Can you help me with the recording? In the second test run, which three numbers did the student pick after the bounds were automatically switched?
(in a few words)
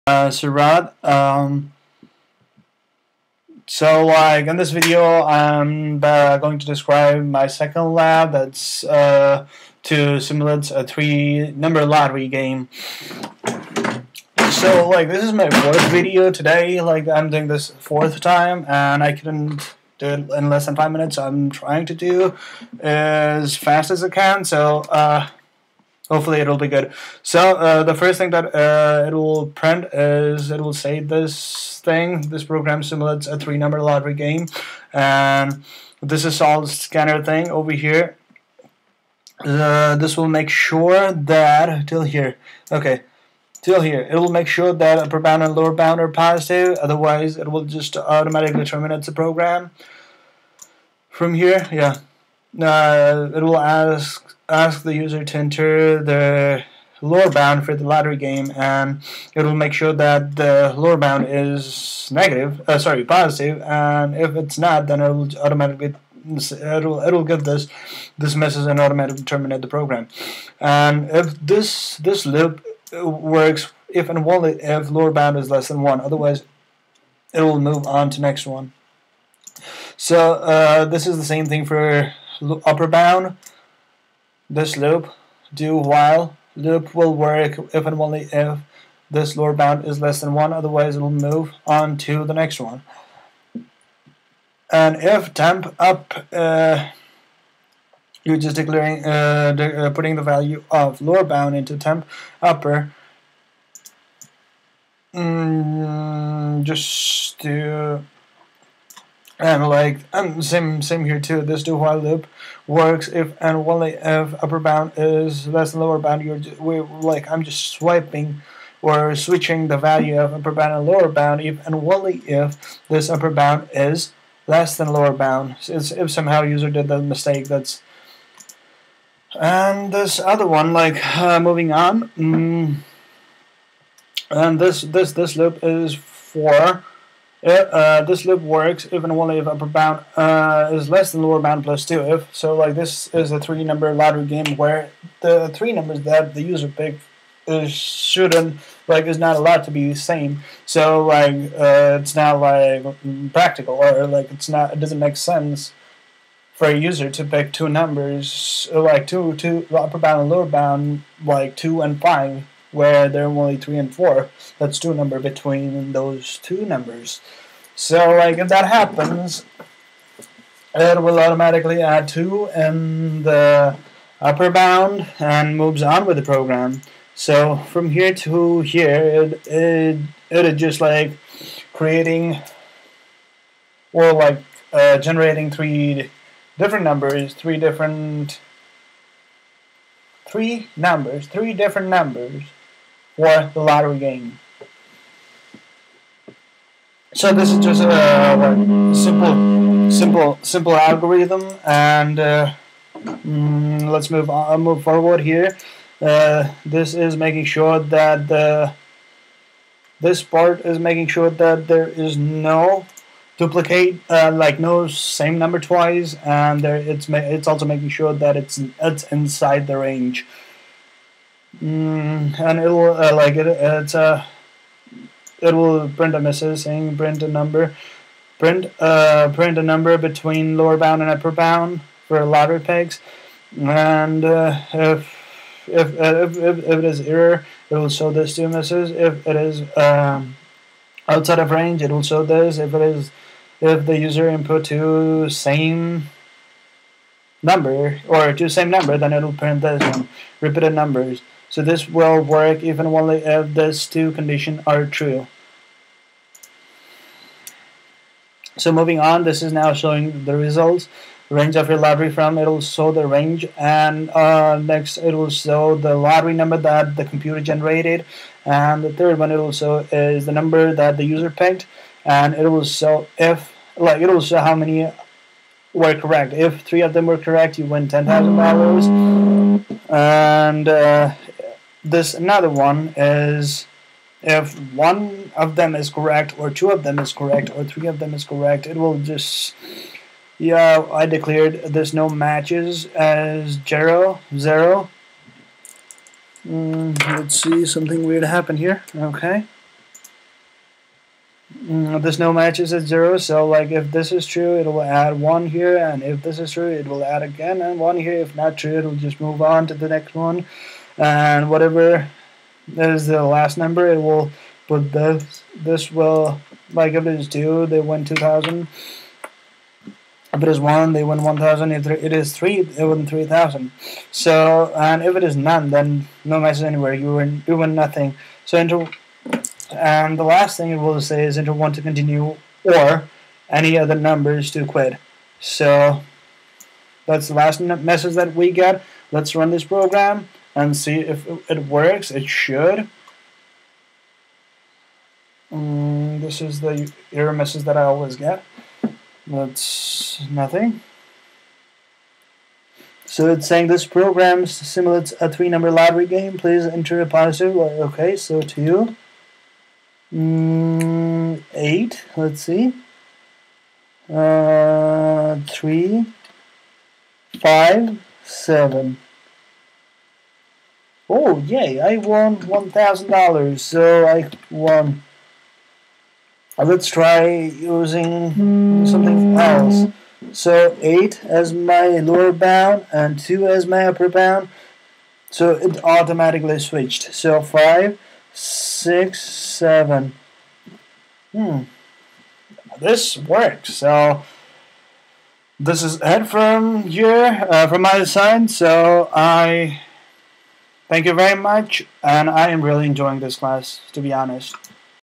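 5, 6, 7.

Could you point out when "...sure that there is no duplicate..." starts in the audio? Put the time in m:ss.
3:31.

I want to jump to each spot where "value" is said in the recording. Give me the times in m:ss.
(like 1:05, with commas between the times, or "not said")
1:40, 1:59.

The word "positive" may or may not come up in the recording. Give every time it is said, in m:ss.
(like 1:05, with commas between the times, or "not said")
0:46, 1:03, 5:57.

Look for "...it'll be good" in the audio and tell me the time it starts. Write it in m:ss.
0:26.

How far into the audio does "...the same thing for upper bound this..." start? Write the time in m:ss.
1:21.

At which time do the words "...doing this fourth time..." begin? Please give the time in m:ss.
0:17.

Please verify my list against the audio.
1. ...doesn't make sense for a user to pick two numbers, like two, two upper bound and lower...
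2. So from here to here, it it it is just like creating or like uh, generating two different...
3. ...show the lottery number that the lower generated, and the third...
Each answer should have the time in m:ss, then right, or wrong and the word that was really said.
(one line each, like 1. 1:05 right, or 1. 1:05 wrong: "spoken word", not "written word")
1. 2:34 right
2. 2:57 wrong: "three", not "two"
3. 4:25 wrong: "computer", not "lower".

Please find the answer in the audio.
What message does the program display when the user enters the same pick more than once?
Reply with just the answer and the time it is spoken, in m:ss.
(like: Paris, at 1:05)
repeated numbers, at 4:10.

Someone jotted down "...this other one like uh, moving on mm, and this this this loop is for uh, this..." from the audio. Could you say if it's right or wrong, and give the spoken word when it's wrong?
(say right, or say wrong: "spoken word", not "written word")
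right.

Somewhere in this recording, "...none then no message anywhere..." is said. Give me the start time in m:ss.
5:25.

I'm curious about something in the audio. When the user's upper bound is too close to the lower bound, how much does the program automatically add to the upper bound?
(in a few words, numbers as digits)
2.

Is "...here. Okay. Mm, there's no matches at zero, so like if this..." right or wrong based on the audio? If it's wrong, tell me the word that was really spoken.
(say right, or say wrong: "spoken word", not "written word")
right.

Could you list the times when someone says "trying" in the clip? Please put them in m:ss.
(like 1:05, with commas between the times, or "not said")
0:21.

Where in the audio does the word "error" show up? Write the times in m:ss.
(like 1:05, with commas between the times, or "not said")
3:57, 5:47.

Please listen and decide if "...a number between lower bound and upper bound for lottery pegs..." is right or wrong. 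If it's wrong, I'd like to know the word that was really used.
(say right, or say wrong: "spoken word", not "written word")
right.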